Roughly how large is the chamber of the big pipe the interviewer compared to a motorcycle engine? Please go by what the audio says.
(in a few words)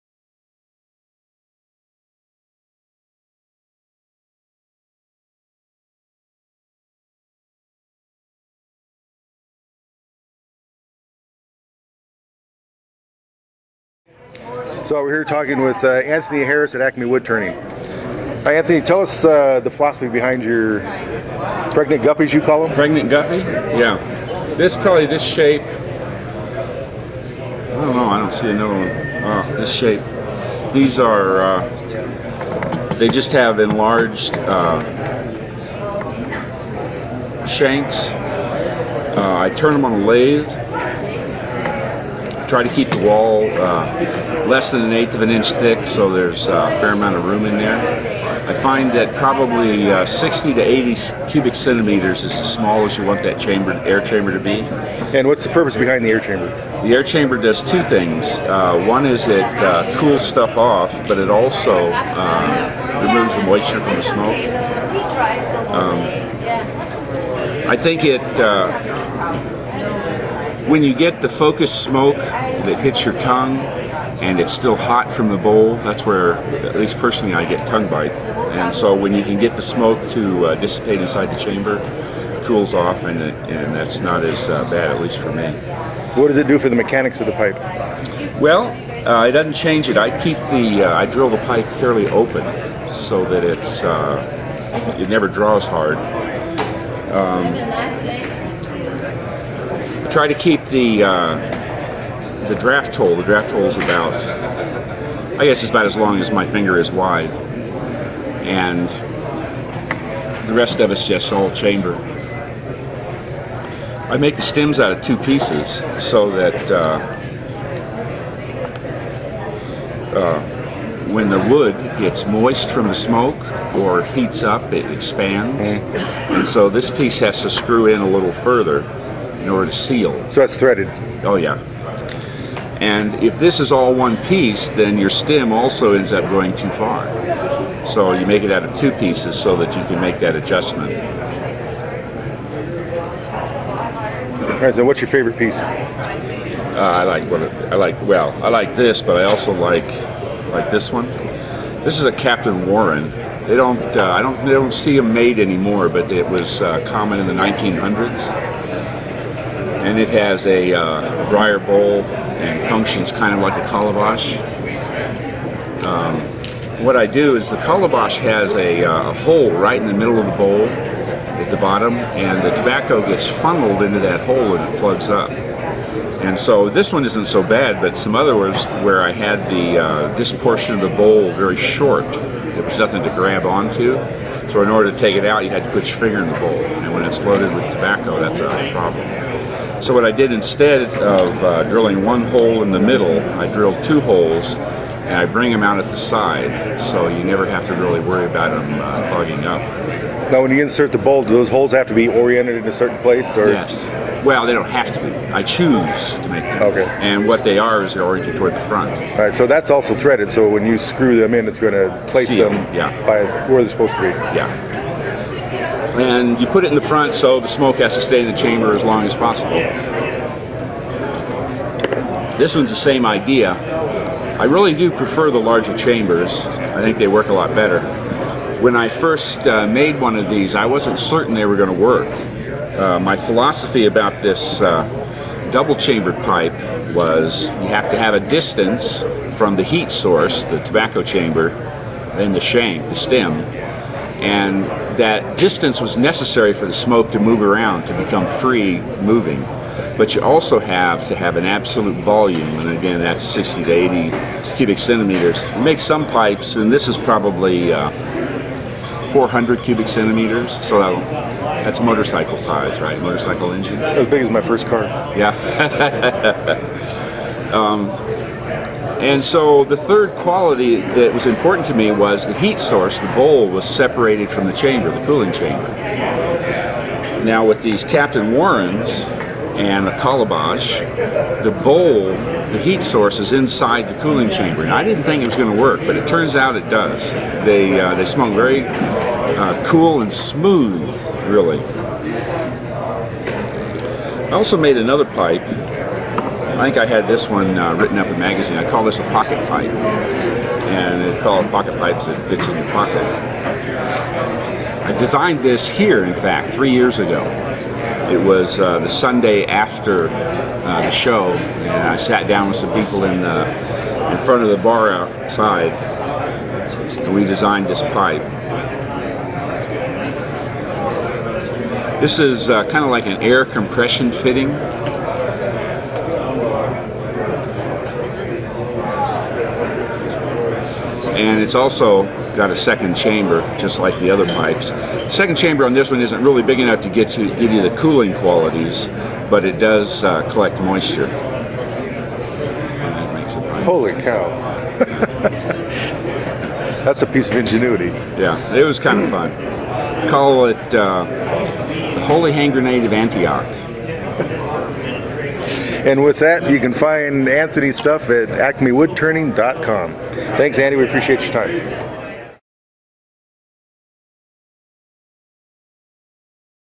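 400 cubic centimeters.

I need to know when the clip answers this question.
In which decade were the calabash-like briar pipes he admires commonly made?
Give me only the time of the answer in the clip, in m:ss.
2:37.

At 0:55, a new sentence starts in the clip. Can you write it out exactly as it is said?
And what's the purpose behind the air chamber?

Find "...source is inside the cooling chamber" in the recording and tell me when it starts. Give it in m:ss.
4:42.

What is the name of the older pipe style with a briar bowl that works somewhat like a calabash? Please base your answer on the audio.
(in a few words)
Captain Warren.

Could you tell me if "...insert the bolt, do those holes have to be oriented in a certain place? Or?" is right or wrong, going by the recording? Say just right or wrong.
right.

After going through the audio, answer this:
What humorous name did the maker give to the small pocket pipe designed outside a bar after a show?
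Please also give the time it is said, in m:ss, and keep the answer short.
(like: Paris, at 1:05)
Holy Hand Grenade of Antioch, at 5:52.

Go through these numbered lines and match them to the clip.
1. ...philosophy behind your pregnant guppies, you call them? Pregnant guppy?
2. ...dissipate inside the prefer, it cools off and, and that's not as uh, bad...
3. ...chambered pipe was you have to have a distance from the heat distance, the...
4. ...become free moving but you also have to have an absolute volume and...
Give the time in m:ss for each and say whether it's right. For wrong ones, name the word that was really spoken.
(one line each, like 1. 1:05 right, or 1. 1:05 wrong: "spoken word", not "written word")
1. 0:19 right
2. 1:20 wrong: "chamber", not "prefer"
3. 3:55 wrong: "source", not "distance"
4. 4:07 right.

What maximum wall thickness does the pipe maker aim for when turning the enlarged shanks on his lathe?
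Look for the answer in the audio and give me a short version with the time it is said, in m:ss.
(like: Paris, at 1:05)
an eighth of an inch, at 0:44.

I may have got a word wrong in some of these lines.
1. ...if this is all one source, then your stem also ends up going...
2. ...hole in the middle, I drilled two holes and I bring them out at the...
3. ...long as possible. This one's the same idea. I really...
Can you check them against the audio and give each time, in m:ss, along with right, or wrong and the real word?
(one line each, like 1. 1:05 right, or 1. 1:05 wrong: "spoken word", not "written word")
1. 2:13 wrong: "piece", not "source"
2. 3:12 right
3. 3:38 right.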